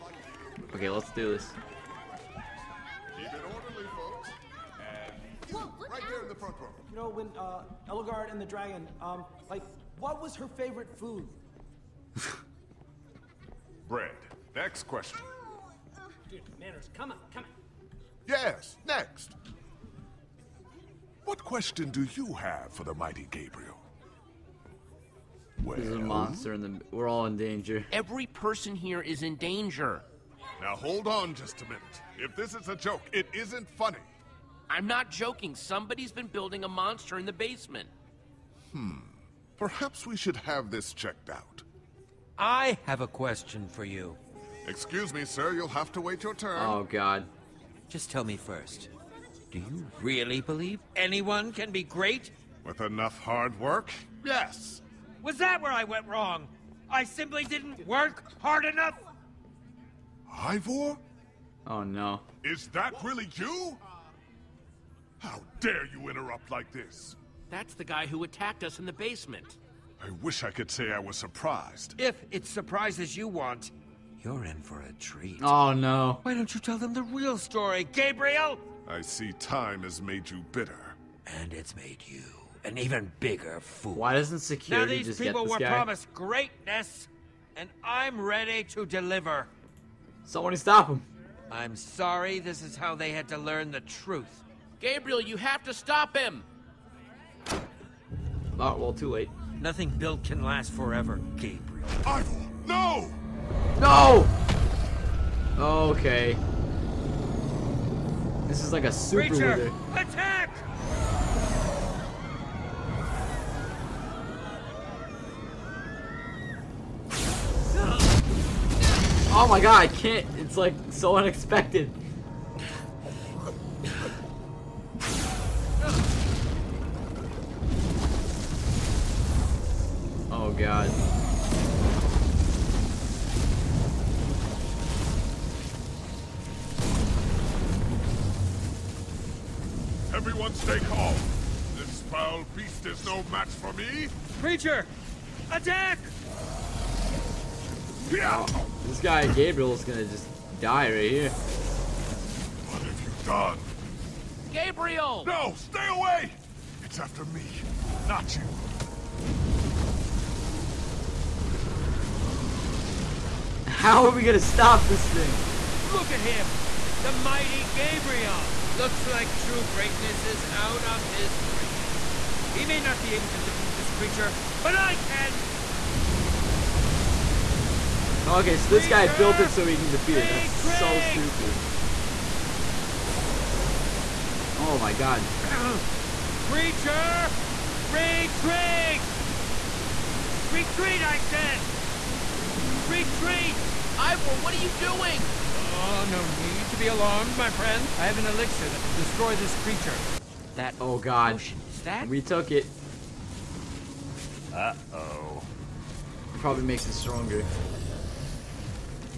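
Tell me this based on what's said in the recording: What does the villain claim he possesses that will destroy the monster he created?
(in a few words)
An elixir.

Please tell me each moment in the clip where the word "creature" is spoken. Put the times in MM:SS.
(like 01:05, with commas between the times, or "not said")
02:53, 03:06, 03:19.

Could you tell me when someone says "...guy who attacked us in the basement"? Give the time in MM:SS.
01:07.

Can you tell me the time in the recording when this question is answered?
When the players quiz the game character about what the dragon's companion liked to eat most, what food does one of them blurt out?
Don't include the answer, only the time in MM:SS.
00:13.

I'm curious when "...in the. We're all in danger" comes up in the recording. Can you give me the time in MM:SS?
00:26.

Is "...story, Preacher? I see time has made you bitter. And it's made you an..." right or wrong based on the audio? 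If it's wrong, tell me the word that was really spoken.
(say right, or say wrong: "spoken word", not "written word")
wrong: "Gabriel", not "Preacher".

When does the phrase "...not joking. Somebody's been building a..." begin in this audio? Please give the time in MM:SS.
00:34.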